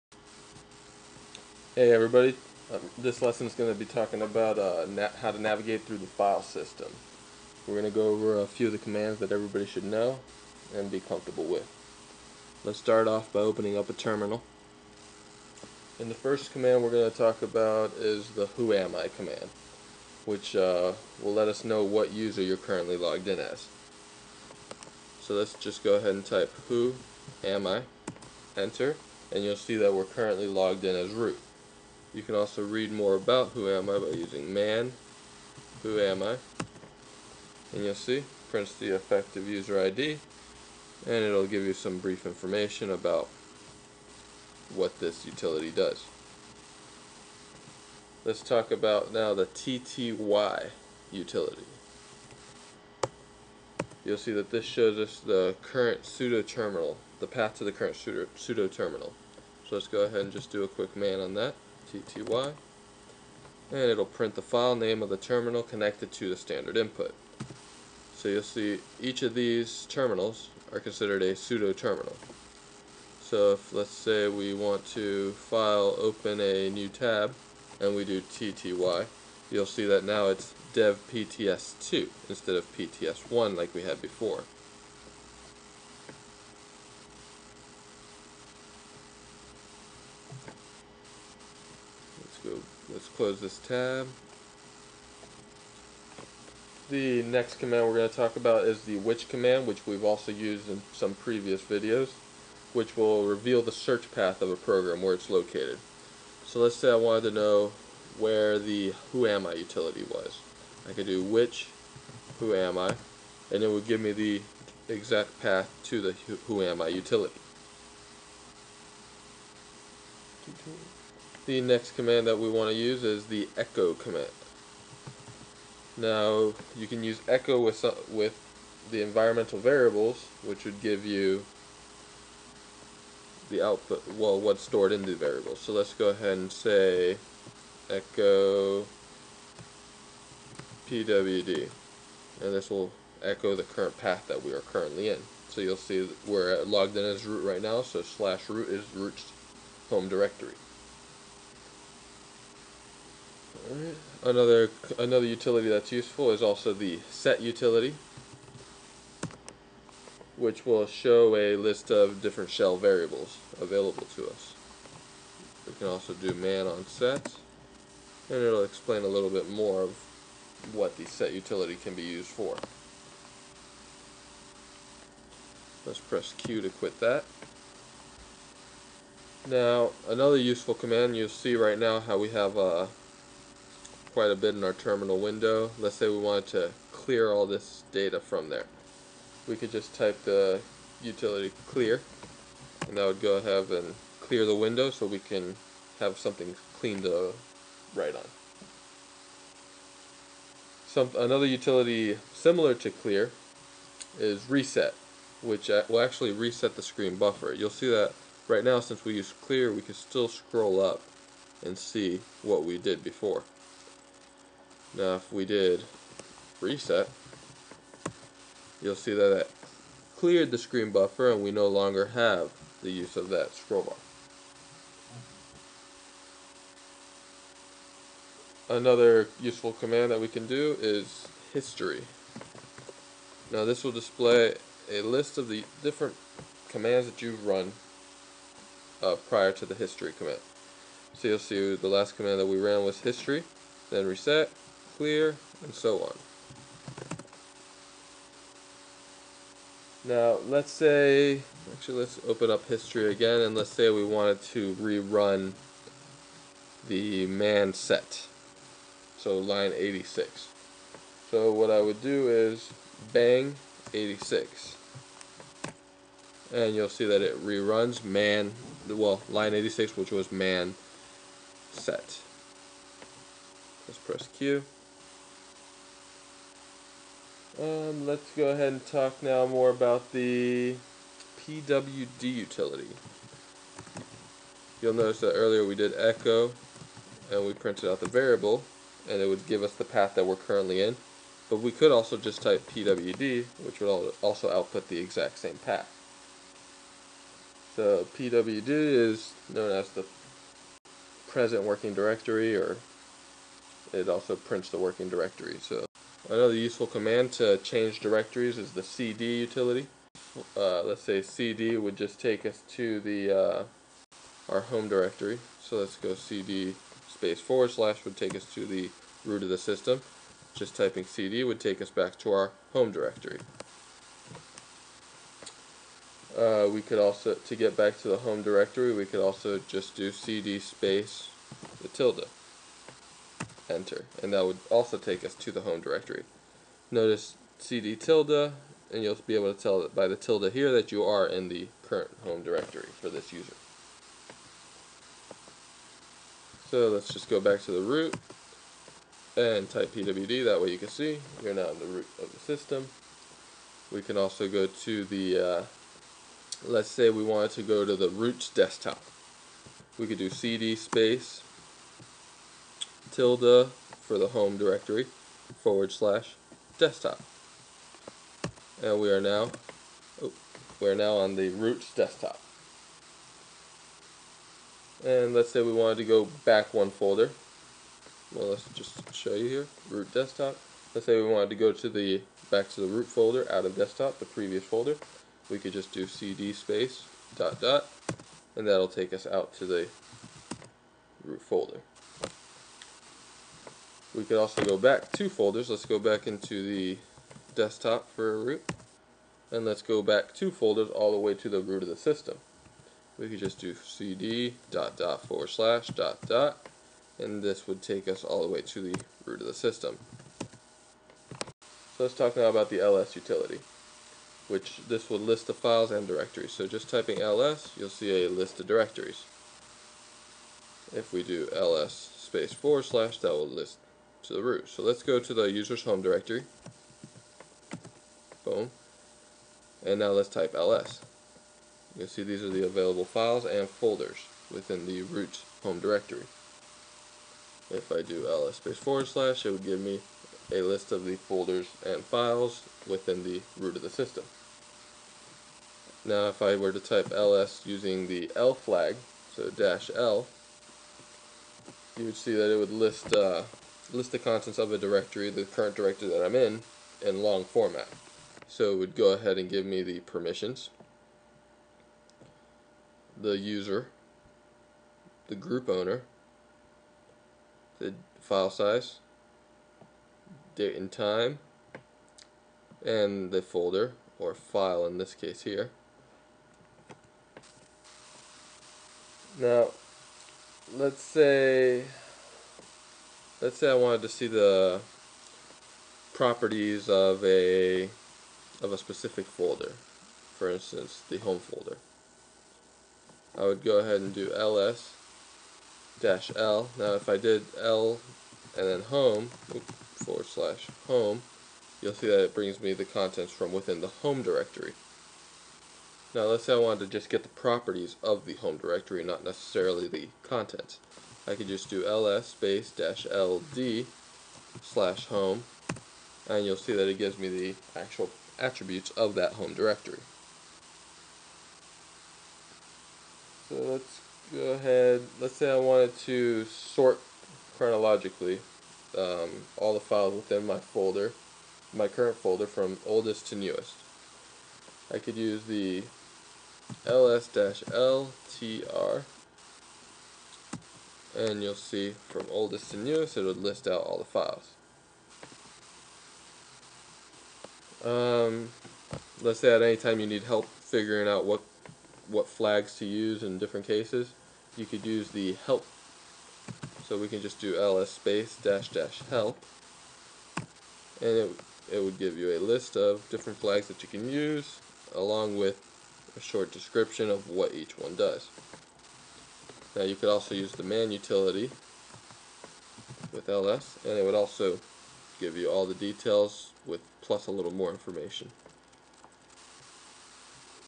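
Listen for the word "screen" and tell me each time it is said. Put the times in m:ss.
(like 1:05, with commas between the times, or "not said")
3:26, 3:40.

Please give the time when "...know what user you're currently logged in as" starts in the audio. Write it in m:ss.
0:21.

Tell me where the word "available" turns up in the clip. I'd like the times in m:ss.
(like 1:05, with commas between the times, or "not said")
2:43, 7:12.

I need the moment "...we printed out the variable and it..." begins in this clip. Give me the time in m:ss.
4:47.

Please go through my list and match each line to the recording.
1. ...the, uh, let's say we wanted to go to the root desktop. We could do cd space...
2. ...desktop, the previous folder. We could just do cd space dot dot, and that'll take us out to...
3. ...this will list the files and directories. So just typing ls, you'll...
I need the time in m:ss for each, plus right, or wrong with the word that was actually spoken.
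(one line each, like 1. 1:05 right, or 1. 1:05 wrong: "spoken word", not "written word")
1. 5:55 right
2. 6:23 right
3. 6:54 right.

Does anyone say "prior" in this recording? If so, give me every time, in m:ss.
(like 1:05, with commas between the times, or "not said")
3:59.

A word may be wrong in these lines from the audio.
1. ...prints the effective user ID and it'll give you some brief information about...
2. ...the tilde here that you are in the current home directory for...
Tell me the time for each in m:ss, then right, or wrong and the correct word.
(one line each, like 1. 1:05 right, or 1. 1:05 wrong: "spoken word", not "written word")
1. 0:38 right
2. 5:40 right.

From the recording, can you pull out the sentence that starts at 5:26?
Uh, we could also, to get back to the home directory, we could also just do cd space the tilde enter.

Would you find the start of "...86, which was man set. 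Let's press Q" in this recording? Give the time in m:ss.
4:29.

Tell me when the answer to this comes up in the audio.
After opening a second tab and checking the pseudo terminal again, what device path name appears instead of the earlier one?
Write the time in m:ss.
1:20.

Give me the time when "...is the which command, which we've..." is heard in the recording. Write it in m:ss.
1:38.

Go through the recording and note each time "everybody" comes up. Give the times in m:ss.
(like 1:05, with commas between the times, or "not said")
0:01, 0:09.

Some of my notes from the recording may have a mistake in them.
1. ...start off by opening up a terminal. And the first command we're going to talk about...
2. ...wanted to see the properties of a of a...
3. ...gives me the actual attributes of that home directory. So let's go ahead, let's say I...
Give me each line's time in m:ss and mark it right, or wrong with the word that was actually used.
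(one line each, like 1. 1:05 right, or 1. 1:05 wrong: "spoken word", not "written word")
1. 0:12 right
2. 8:03 right
3. 8:36 right.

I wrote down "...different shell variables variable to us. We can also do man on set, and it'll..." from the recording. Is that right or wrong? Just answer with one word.
wrong.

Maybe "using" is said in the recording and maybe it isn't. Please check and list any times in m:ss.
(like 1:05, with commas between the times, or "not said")
0:34, 7:27.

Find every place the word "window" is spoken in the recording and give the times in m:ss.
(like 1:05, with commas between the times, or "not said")
3:05, 3:14.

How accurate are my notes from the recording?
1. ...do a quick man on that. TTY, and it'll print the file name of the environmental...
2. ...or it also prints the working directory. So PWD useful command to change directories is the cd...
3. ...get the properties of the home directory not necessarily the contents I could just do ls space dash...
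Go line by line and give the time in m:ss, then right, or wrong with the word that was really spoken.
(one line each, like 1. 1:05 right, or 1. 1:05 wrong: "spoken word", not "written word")
1. 1:00 wrong: "terminal", not "environmental"
2. 5:02 wrong: "Another", not "PWD"
3. 8:27 right.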